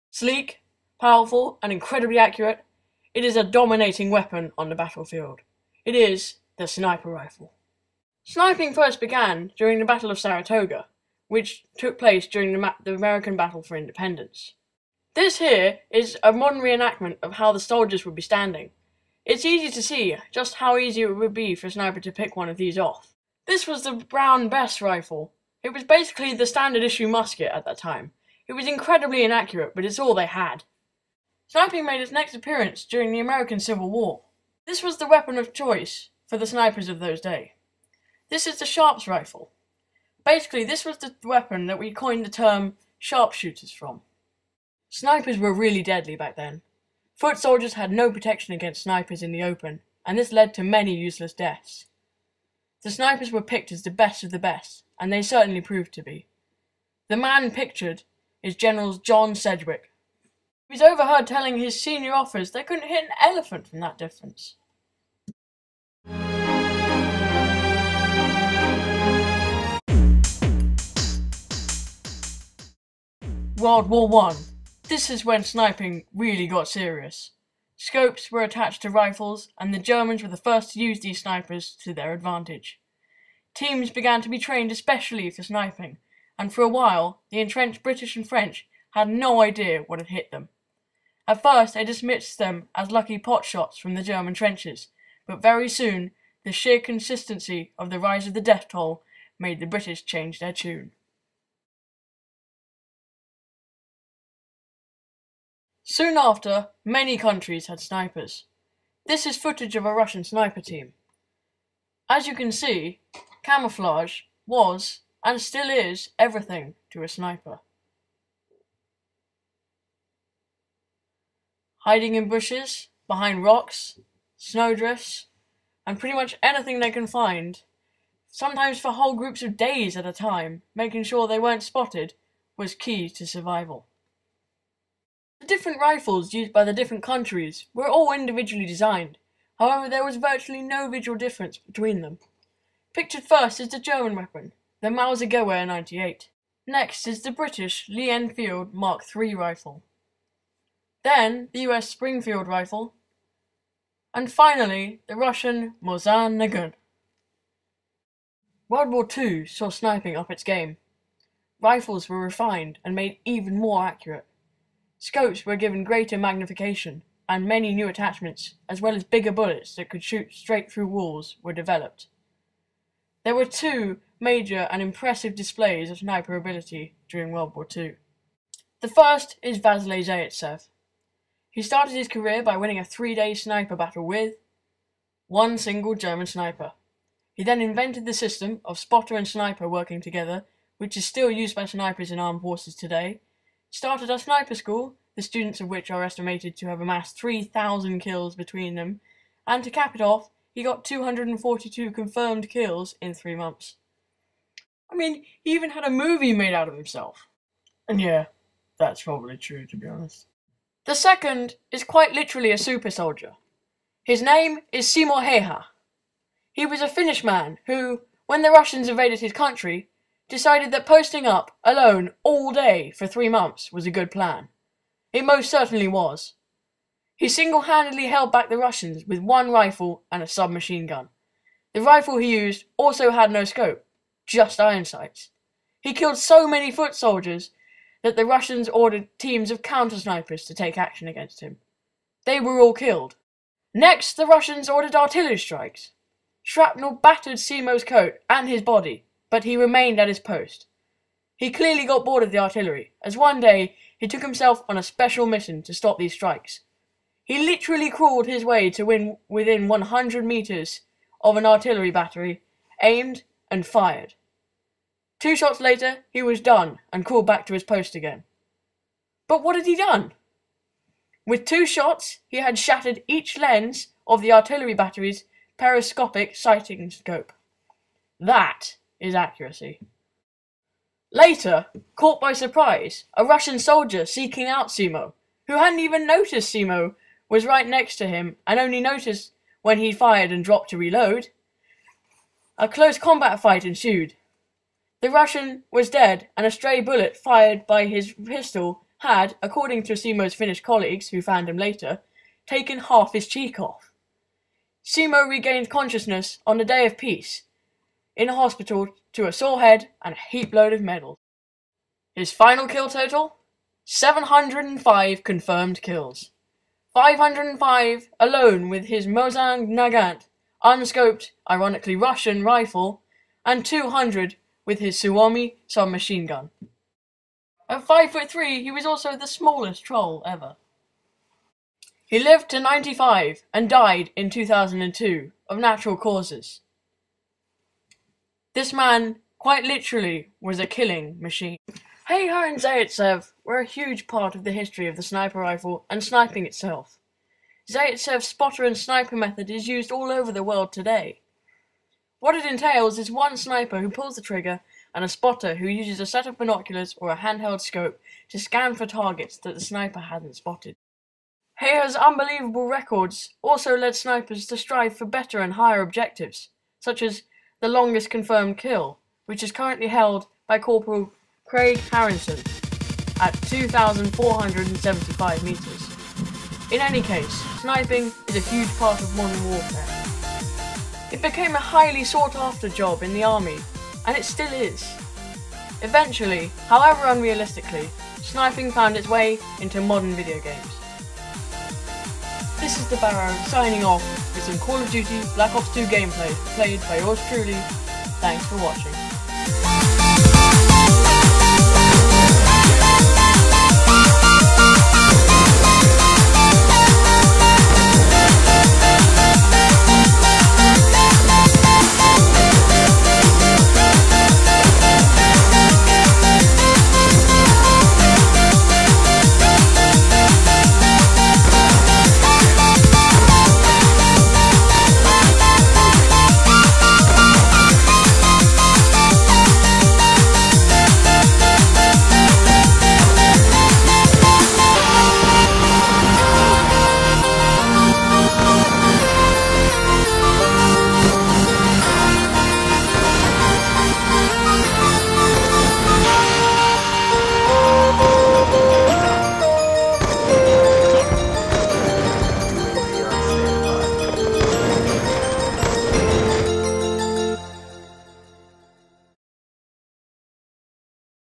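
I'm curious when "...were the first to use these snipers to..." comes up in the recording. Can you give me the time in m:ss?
1:20.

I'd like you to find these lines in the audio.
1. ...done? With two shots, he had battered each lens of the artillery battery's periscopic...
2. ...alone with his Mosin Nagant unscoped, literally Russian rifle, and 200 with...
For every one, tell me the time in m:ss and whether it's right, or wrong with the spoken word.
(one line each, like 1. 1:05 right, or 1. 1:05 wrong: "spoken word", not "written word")
1. 4:29 wrong: "shattered", not "battered"
2. 5:18 wrong: "ironically", not "literally".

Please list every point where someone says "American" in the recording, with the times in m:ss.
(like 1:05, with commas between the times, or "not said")
0:12, 0:33.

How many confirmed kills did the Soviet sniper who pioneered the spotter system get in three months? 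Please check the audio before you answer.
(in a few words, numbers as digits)
242.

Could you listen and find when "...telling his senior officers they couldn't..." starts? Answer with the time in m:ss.
1:01.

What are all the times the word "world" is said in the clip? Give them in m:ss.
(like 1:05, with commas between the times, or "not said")
1:13, 2:38, 2:57, 5:50.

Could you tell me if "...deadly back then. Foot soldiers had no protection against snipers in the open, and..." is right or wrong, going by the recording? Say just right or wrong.
right.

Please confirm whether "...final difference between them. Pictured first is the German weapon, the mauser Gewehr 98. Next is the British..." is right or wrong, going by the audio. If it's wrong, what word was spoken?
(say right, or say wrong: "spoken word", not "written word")
wrong: "visual", not "final".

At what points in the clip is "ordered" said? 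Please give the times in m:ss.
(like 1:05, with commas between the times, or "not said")
3:58, 4:04.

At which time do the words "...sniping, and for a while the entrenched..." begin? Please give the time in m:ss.
1:25.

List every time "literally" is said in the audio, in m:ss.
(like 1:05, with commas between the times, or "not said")
3:32, 4:17, 5:39.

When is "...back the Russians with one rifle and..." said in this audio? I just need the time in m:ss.
3:48.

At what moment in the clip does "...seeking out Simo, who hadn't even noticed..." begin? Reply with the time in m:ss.
4:44.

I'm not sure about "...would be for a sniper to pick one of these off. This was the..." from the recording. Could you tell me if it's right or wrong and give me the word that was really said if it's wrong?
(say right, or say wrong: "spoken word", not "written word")
right.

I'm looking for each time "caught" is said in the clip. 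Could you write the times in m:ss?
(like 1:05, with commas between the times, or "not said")
4:41.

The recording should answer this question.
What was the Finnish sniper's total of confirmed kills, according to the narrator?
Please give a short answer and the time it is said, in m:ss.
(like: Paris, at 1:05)
705, at 5:13.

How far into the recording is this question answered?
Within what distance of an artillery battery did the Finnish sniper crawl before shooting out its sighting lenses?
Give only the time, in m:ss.
4:19.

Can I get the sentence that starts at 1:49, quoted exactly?
This is footage of a Russian sniper team.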